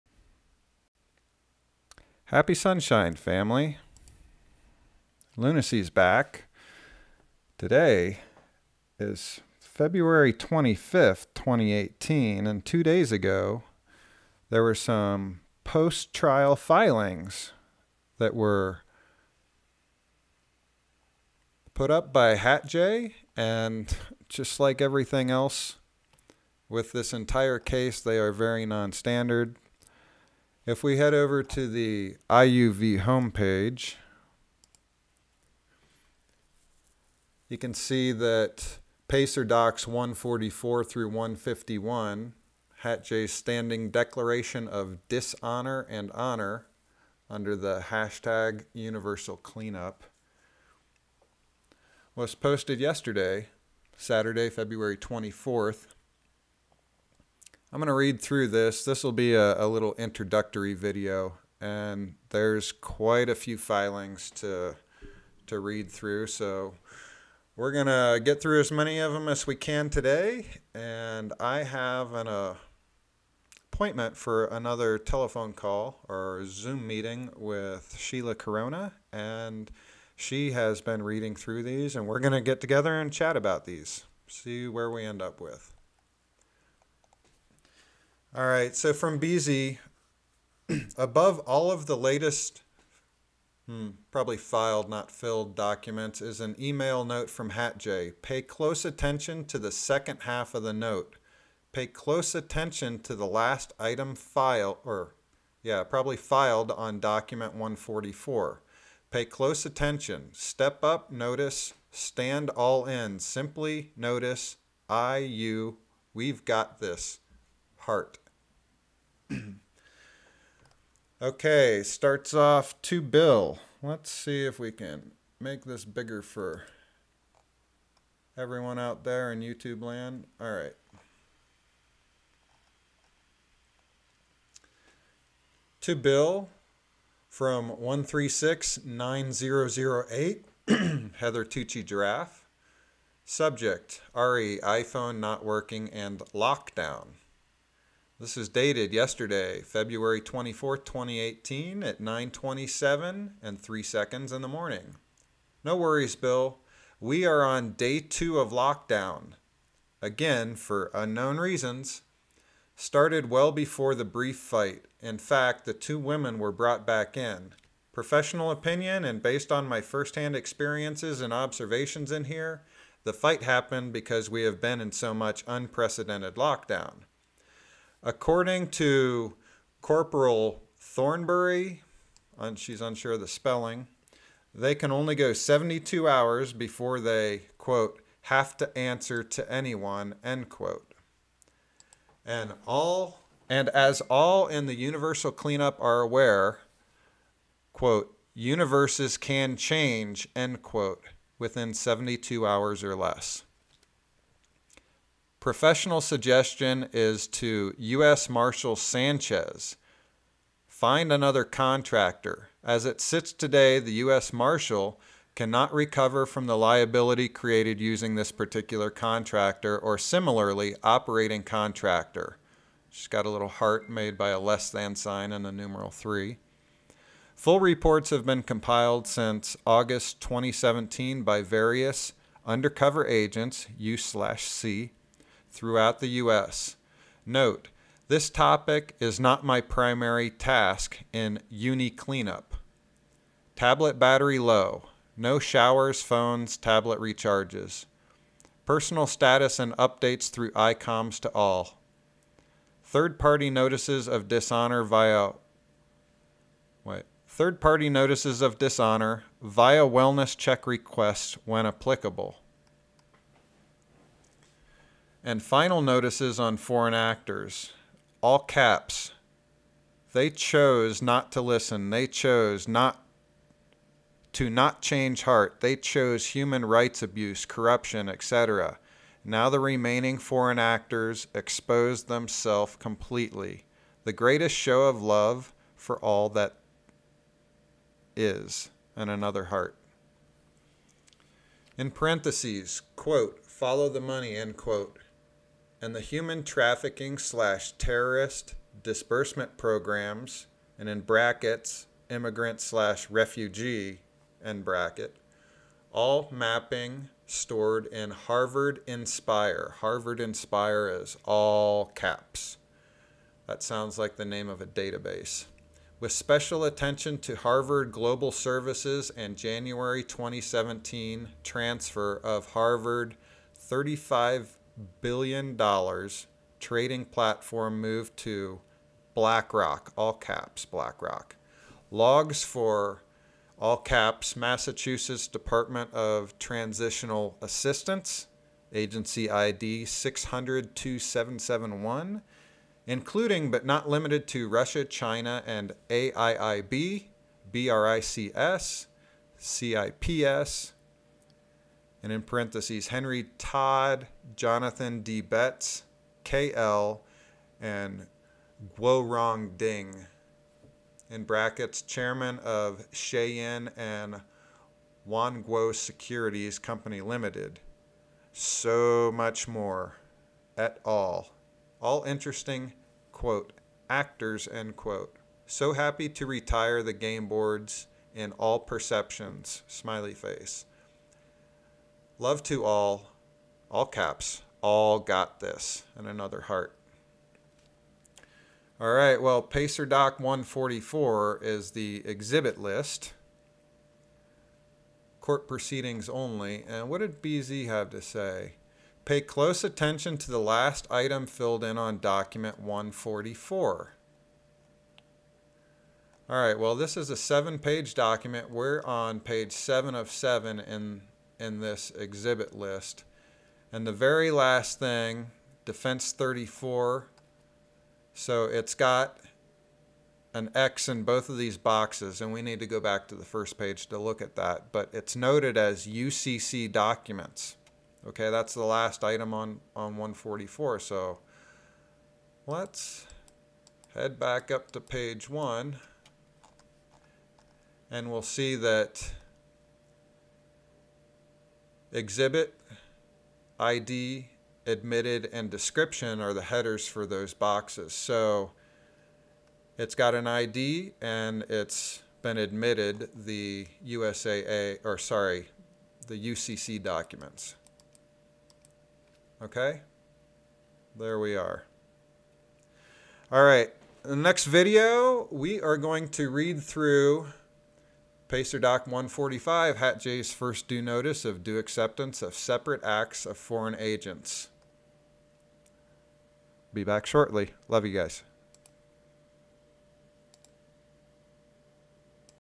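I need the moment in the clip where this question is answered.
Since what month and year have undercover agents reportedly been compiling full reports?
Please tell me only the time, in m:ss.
3:49.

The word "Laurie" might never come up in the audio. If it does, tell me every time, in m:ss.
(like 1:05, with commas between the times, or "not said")
not said.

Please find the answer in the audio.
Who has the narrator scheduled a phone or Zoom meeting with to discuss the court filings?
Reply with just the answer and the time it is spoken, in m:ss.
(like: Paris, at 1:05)
Sheila Corona, at 1:17.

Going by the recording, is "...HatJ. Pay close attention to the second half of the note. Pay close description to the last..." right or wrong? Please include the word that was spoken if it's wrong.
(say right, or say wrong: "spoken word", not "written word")
wrong: "attention", not "description".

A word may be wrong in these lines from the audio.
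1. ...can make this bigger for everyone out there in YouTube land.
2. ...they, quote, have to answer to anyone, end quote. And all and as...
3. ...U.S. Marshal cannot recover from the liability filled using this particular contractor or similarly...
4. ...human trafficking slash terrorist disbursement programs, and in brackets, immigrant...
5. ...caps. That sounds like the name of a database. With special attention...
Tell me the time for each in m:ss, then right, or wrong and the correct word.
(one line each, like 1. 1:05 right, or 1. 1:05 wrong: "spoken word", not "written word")
1. 2:04 right
2. 3:06 right
3. 3:34 wrong: "created", not "filled"
4. 4:56 right
5. 5:11 right.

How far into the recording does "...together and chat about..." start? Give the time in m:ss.
1:22.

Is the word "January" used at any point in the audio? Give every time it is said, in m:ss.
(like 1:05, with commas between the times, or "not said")
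5:19.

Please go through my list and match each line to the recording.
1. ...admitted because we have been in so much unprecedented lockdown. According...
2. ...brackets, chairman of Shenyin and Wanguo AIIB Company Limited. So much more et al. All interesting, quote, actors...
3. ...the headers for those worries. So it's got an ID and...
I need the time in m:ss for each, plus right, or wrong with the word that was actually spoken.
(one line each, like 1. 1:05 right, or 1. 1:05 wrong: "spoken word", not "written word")
1. 2:53 wrong: "happened", not "admitted"
2. 6:01 wrong: "Securities", not "AIIB"
3. 7:26 wrong: "boxes", not "worries".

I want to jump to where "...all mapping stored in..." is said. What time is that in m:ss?
5:05.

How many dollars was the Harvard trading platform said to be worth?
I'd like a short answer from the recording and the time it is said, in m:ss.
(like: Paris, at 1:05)
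35 billion dollars, at 5:23.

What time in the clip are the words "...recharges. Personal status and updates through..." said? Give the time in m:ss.
4:06.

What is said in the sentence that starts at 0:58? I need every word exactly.
This will be a, a, little introductory video, and there's quite a few filings to, to read through.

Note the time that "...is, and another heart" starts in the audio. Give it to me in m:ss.
4:48.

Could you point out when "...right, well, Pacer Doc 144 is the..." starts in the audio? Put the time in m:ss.
6:28.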